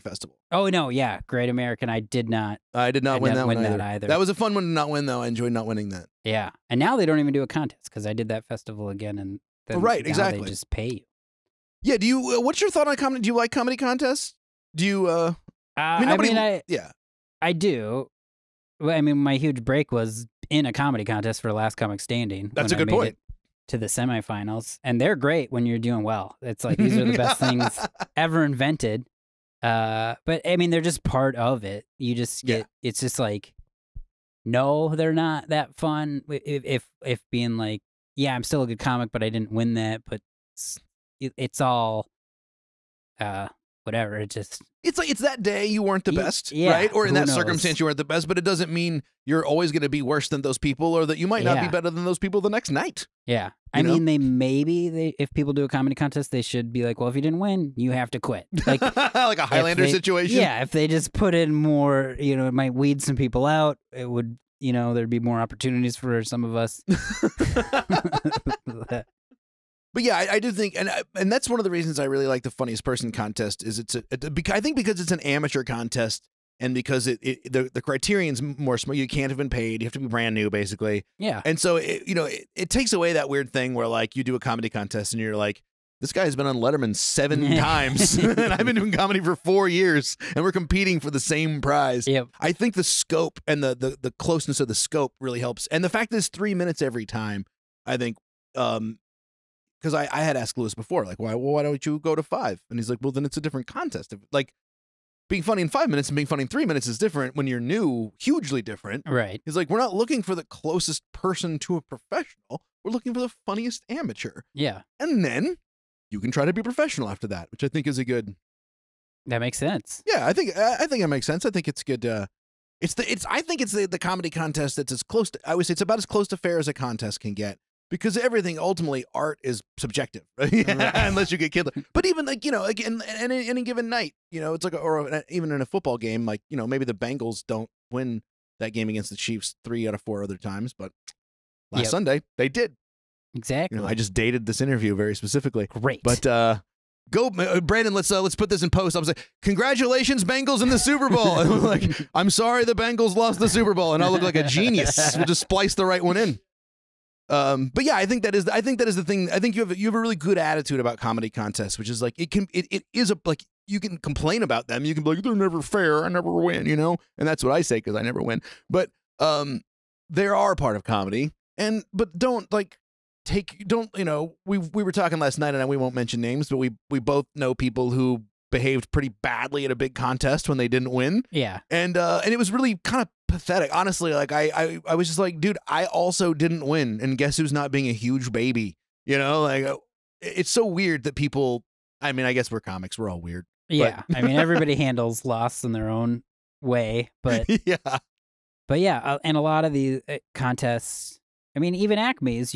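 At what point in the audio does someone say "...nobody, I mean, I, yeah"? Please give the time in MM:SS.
00:16.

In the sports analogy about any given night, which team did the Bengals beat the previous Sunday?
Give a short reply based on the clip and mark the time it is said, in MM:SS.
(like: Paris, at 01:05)
Chiefs, at 02:19.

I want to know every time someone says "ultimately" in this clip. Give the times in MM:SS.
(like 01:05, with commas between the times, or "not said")
02:08.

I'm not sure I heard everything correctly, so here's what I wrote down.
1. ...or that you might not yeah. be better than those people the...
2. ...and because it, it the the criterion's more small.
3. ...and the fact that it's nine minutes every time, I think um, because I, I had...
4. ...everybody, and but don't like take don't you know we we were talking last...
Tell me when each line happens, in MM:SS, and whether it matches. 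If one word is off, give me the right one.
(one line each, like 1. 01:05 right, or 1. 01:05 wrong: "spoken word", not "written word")
1. 00:50 right
2. 01:16 right
3. 01:35 wrong: "three", not "nine"
4. 02:50 wrong: "comedy", not "everybody".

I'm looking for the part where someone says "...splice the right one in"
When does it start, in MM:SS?
02:35.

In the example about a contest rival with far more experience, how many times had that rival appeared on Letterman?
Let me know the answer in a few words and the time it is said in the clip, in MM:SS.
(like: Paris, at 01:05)
7, at 01:26.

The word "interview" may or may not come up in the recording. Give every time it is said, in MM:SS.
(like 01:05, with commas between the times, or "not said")
02:24.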